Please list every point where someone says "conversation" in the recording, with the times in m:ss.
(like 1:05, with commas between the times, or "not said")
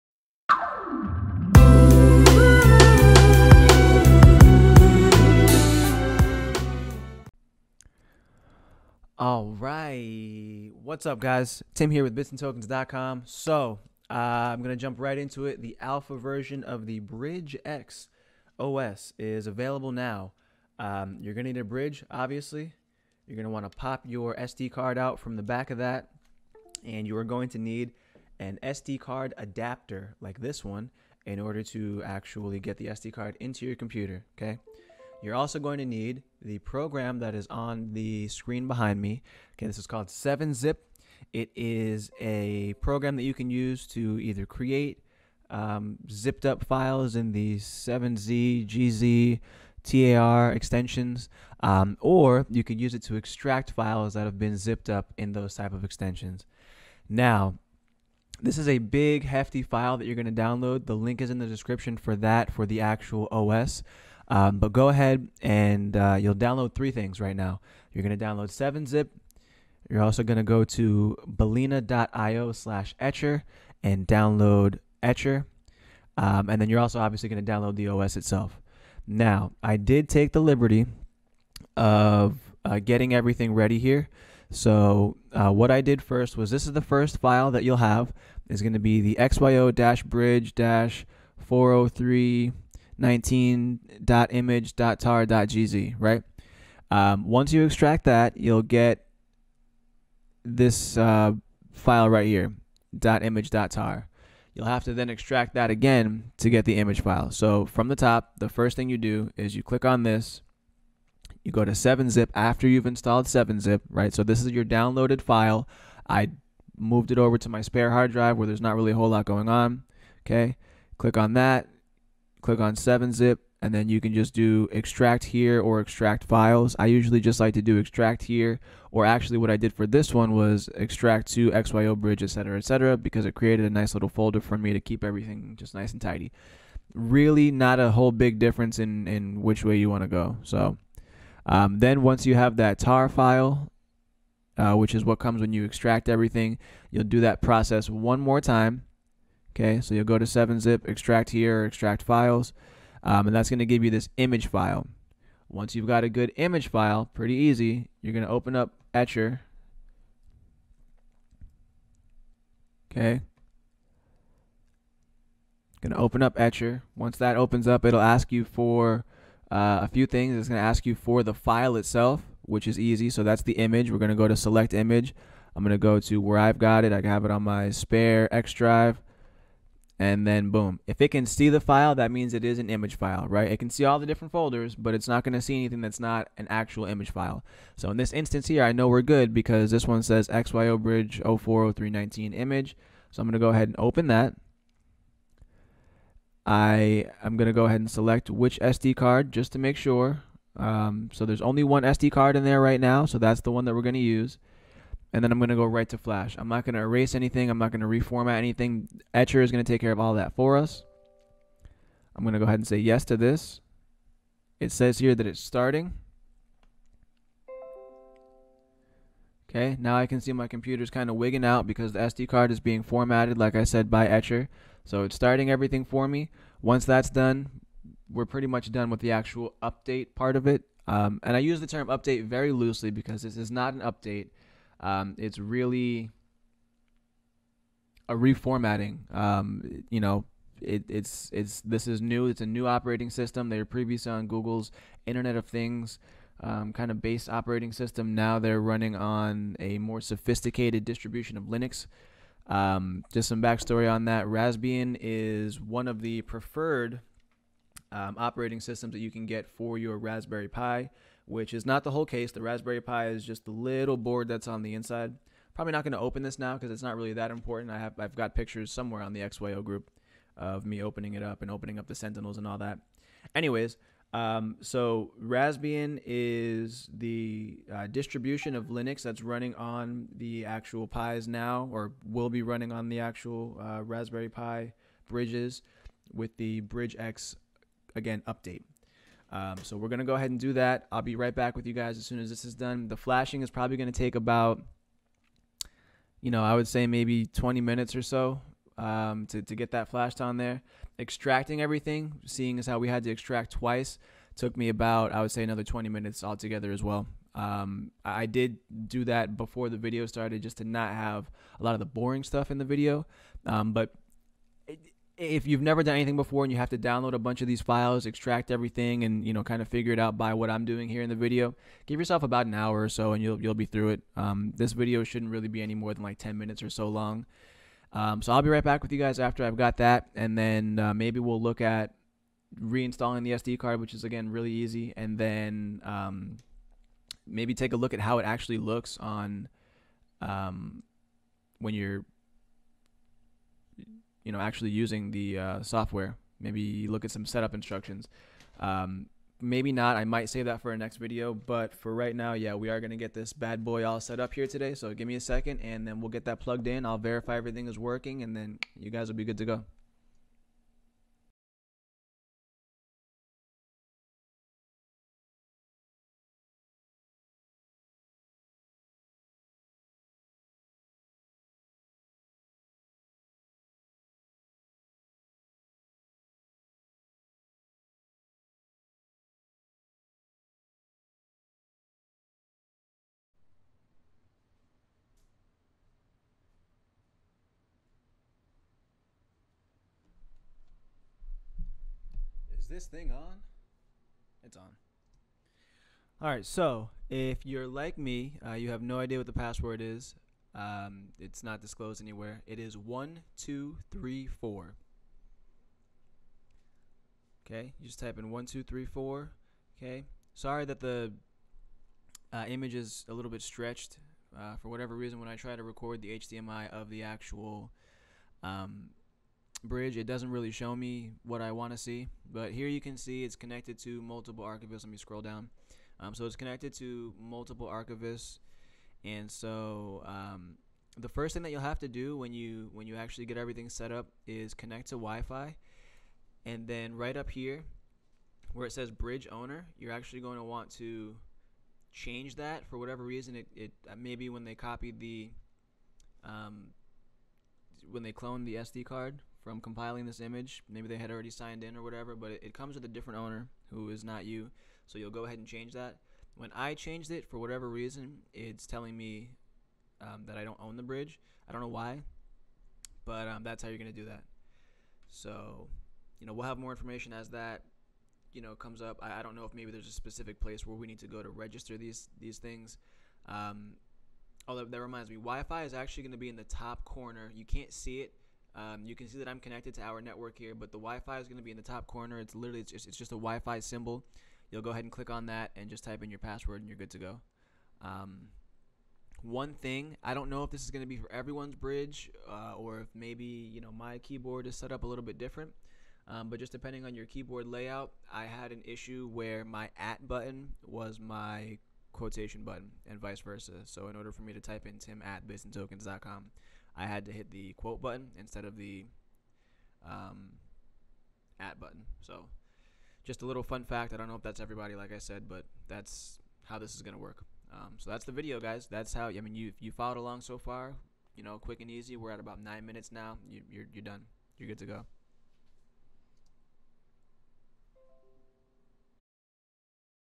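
not said.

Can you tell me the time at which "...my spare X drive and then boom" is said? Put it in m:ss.
2:57.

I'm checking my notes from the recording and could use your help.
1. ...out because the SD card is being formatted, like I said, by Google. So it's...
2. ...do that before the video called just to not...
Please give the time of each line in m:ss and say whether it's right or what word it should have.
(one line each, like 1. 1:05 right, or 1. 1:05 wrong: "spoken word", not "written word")
1. 3:41 wrong: "Etcher", not "Google"
2. 5:08 wrong: "started", not "called".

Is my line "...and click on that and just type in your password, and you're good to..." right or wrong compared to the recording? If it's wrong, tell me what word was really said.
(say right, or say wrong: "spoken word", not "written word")
right.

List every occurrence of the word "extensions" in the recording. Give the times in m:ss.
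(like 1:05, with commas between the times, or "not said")
0:50, 0:55.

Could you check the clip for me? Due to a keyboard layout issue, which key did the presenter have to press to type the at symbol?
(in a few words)
the quote button.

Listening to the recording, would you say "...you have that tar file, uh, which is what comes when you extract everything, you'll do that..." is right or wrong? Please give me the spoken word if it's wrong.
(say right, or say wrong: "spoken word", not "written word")
right.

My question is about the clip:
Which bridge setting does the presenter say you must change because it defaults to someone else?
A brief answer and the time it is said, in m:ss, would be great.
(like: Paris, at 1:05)
bridge owner, at 7:18.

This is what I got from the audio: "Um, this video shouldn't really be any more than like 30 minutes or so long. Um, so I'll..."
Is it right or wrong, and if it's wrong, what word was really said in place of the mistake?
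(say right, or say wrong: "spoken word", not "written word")
wrong: "10", not "30".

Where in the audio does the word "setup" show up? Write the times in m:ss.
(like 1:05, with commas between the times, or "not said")
5:47.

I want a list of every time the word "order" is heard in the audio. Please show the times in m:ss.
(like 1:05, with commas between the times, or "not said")
0:31, 8:23.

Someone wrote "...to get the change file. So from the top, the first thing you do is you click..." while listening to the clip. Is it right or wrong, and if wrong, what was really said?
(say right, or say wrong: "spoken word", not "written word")
wrong: "image", not "change".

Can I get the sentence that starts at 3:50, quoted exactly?
Um, and I use the term update very loosely because this is not an update.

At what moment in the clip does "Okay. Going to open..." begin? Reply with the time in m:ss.
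2:42.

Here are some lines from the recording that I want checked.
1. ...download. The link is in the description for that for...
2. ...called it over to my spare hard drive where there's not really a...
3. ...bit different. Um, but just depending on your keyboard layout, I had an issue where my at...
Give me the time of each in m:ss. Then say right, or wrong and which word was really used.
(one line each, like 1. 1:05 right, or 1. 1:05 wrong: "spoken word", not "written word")
1. 1:00 right
2. 1:56 wrong: "moved", not "called"
3. 8:15 right.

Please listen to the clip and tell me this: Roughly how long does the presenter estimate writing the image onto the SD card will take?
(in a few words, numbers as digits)
20 minutes.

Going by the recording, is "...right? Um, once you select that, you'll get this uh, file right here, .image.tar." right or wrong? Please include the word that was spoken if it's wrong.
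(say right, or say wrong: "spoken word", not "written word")
wrong: "extract", not "select".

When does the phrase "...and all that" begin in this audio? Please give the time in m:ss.
4:32.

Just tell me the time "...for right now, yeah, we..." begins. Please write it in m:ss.
5:51.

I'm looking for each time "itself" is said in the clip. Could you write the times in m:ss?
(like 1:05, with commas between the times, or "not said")
1:18, 2:51.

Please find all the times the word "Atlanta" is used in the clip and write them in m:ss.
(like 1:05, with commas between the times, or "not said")
not said.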